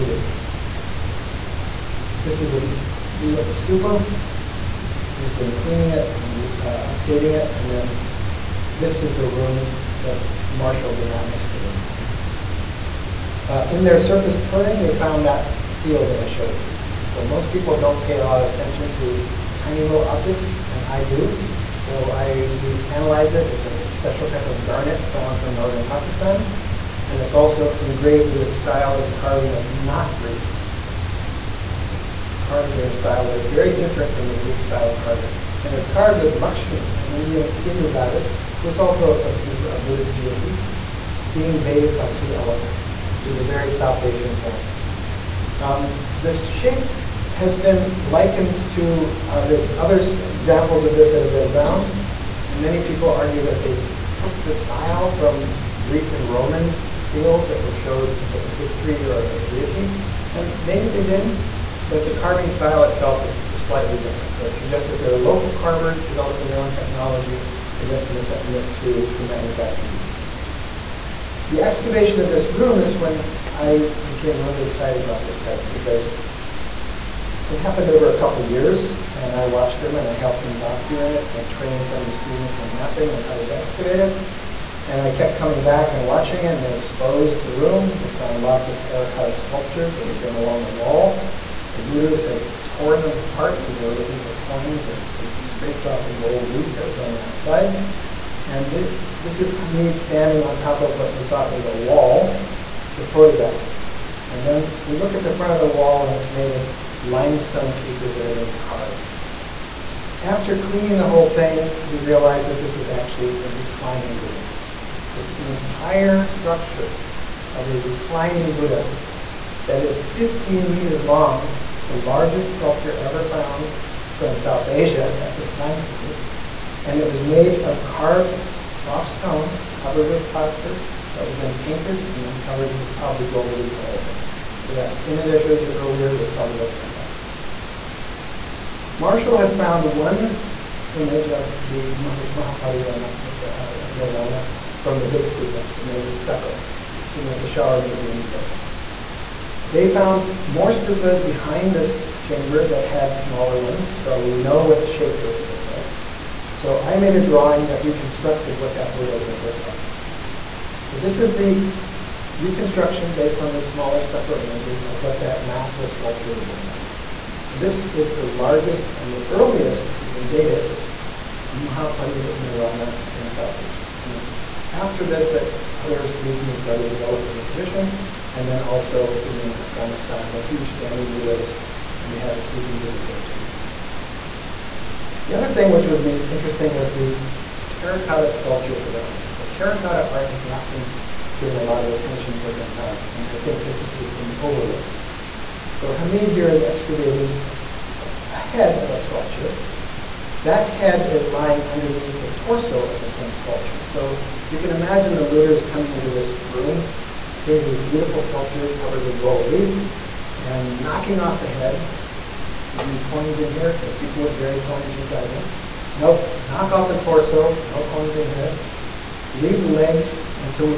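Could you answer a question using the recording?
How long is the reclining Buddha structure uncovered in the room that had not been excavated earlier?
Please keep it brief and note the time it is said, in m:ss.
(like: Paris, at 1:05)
15 meters, at 2:00.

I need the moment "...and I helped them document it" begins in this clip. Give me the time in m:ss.
1:19.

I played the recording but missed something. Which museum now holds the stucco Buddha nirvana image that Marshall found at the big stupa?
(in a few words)
Peshawar Museum.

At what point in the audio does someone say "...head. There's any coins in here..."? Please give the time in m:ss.
3:31.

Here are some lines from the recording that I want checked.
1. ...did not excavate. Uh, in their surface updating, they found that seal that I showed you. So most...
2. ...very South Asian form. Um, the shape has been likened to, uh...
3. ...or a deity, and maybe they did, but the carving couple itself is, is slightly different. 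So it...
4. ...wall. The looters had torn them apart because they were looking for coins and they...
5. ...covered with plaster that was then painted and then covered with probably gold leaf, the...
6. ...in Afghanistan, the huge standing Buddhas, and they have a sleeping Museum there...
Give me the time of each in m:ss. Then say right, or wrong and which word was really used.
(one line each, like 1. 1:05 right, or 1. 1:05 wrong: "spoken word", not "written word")
1. 0:10 wrong: "clearing", not "updating"
2. 0:43 right
3. 0:59 wrong: "style", not "couple"
4. 1:30 right
5. 2:09 right
6. 2:59 wrong: "Buddha", not "Museum".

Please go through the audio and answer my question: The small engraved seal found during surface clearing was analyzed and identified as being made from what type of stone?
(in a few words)
Garnet.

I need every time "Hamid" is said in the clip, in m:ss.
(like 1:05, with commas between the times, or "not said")
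1:39, 3:15.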